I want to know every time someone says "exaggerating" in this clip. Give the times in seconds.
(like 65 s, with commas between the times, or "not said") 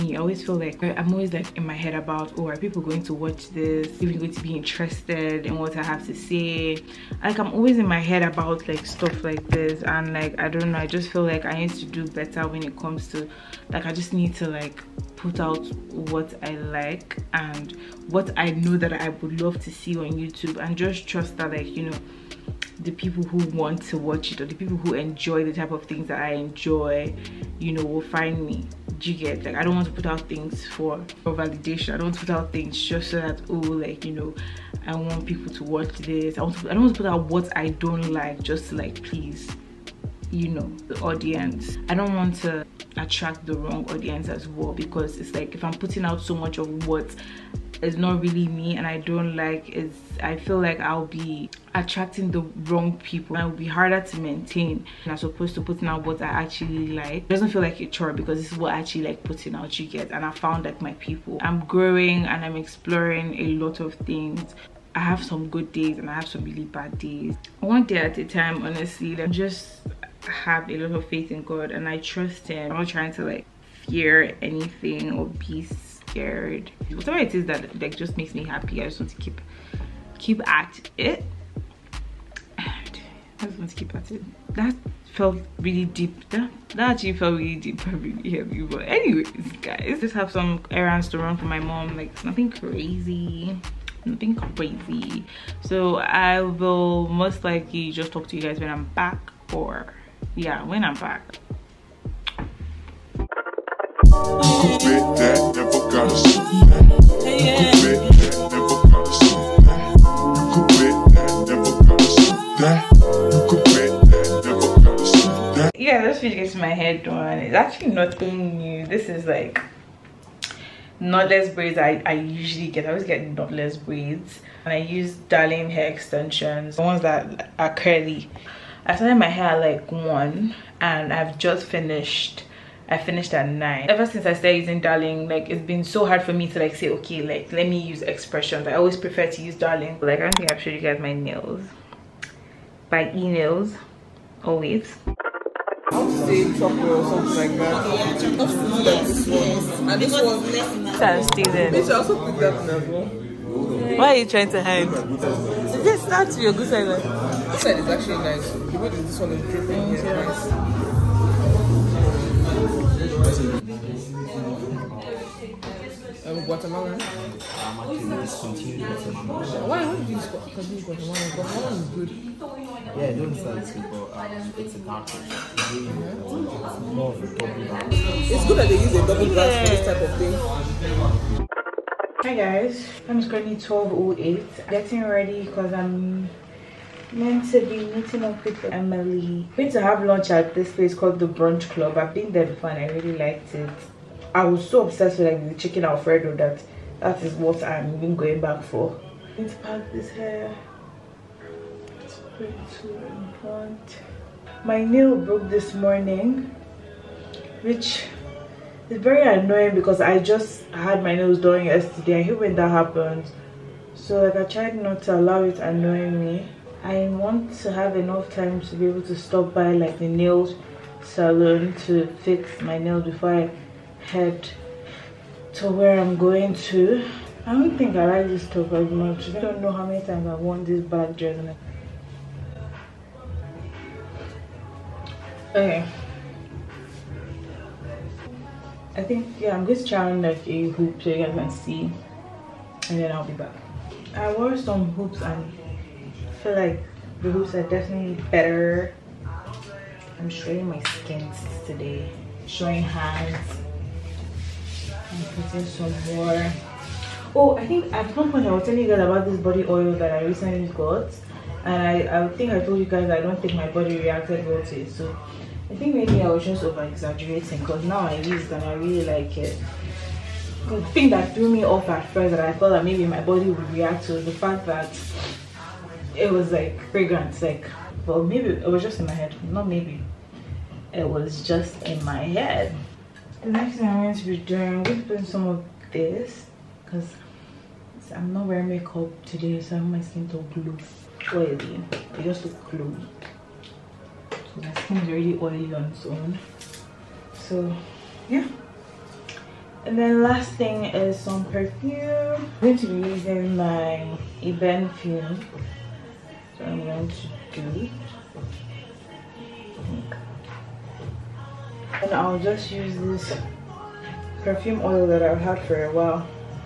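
266 s.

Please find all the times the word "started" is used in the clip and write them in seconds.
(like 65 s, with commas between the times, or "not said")
128 s, 134 s.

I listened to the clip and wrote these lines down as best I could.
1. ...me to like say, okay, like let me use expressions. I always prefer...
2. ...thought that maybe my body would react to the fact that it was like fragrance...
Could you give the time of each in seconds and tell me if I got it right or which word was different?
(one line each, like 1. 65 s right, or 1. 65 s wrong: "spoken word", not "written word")
1. 136 s right
2. 272 s right.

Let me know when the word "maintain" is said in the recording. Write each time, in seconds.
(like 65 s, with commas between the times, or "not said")
54 s.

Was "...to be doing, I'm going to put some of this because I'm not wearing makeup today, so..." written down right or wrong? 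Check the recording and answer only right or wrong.
right.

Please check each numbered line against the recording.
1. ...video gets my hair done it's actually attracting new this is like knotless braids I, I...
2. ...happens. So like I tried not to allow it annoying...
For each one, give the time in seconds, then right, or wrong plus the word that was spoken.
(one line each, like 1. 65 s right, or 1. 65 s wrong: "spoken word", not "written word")
1. 116 s wrong: "nothing", not "attracting"
2. 212 s right.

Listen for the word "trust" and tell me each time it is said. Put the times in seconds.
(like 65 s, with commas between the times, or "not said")
21 s, 71 s.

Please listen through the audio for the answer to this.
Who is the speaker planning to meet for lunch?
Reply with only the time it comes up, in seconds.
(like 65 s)
188 s.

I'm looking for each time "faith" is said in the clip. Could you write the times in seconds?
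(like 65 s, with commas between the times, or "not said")
71 s.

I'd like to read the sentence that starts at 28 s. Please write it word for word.
Do you get like I don't want to put out things for, for validation.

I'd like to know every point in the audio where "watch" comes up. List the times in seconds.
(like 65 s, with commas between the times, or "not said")
3 s, 23 s, 35 s.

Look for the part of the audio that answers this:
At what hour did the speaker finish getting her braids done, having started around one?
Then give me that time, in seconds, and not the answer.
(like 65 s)
132 s.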